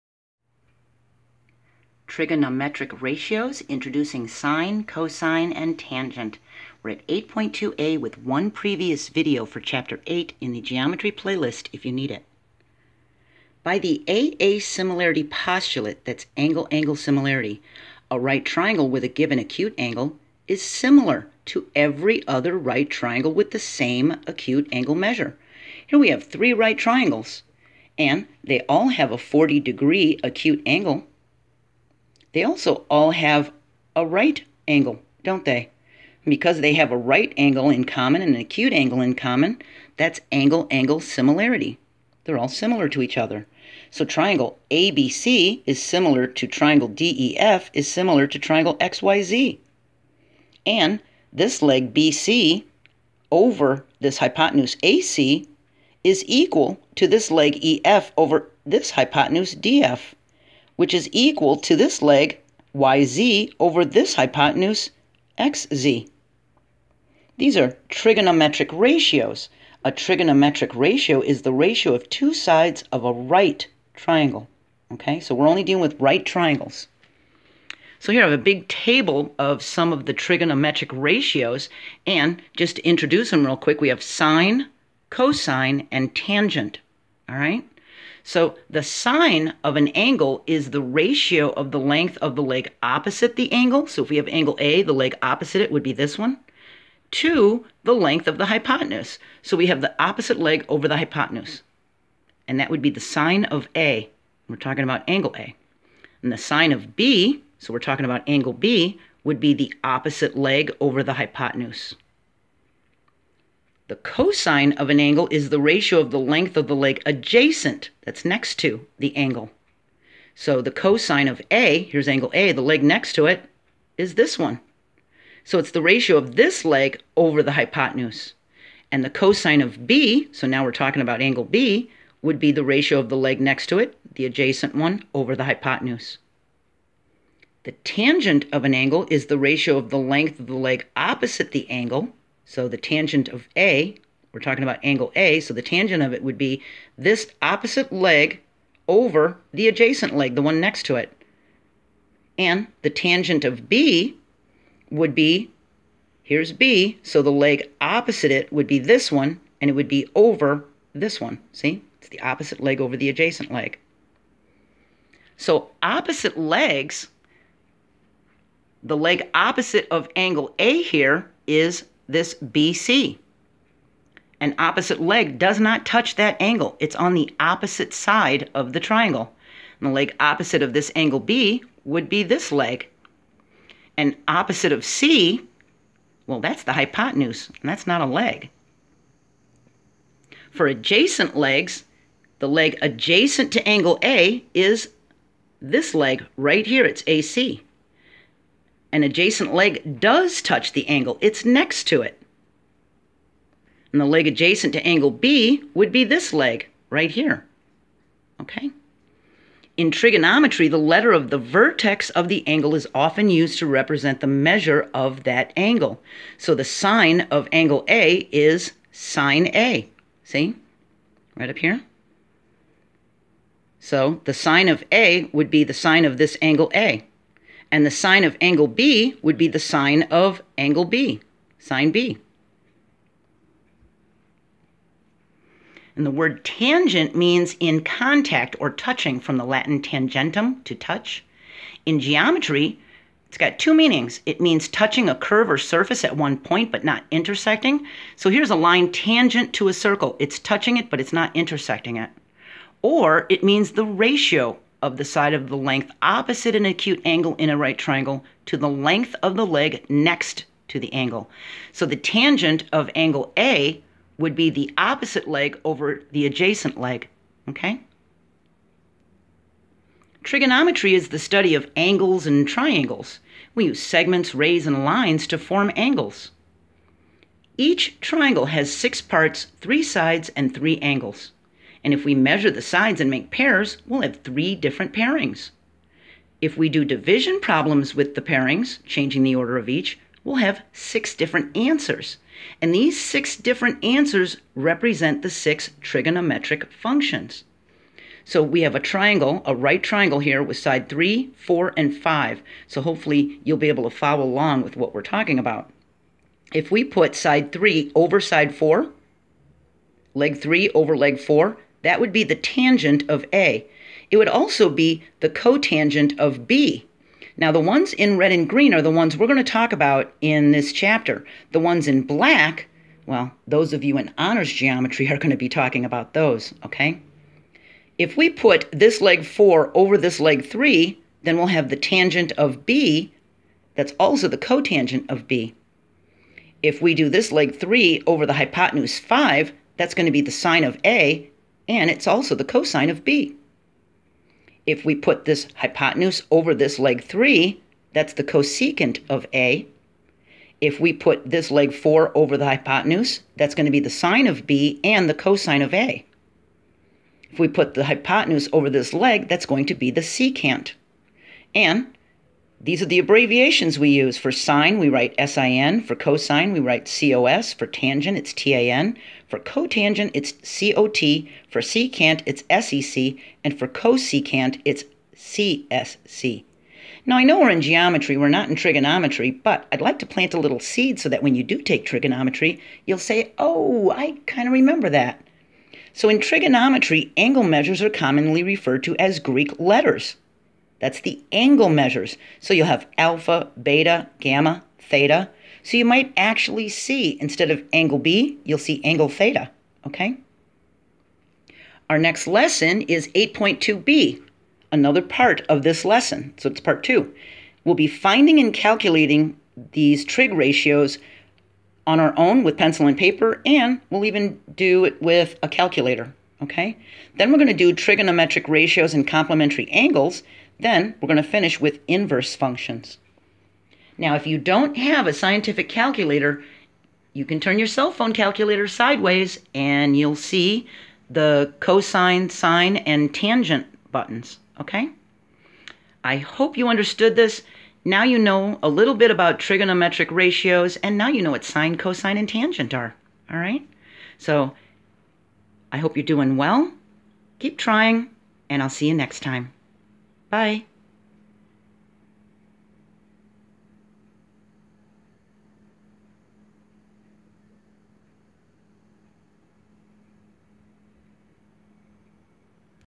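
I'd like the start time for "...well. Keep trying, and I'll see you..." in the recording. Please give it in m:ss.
7:26.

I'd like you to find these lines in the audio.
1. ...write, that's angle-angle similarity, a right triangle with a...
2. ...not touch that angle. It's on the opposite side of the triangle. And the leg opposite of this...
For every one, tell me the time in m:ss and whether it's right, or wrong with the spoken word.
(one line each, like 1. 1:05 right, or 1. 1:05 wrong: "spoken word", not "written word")
1. 0:15 wrong: "postulate", not "write"
2. 2:55 right.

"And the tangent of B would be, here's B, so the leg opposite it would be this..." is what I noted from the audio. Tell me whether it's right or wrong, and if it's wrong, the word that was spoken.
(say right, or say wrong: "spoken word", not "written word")
right.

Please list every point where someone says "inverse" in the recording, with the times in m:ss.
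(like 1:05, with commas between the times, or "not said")
7:01.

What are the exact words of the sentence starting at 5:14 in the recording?
It would also be the cotangent of B.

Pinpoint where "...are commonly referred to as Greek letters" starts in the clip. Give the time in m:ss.
6:27.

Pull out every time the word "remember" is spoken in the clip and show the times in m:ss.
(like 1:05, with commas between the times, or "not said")
6:24.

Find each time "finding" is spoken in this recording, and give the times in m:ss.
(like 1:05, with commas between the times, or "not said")
6:47.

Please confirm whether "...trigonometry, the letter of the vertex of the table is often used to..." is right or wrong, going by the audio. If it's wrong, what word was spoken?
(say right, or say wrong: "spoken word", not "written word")
wrong: "angle", not "table".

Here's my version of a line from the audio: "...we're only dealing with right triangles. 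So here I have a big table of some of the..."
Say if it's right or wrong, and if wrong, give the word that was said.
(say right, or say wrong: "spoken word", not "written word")
right.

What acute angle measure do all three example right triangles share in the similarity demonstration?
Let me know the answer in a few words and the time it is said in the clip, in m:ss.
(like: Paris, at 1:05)
40 degrees, at 0:29.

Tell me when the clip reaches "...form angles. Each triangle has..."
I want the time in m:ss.
4:35.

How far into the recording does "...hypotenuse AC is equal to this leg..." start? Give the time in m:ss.
0:54.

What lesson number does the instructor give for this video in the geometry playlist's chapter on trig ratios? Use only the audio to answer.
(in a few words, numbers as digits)
8.2a.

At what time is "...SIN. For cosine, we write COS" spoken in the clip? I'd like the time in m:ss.
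6:05.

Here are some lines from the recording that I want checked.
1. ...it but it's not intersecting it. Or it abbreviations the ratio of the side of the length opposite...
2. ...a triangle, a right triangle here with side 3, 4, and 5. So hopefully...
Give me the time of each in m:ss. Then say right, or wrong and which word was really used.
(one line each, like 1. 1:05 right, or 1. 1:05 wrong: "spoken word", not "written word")
1. 4:10 wrong: "means", not "abbreviations"
2. 4:58 right.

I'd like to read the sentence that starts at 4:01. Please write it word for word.
In geometry, it's got two meanings.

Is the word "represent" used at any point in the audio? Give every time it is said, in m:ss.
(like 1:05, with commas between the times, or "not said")
3:33, 4:54.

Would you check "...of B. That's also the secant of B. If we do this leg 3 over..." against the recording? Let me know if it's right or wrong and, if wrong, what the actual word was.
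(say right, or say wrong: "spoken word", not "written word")
wrong: "cotangent", not "secant".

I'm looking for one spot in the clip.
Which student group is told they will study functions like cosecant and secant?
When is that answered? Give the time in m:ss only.
5:24.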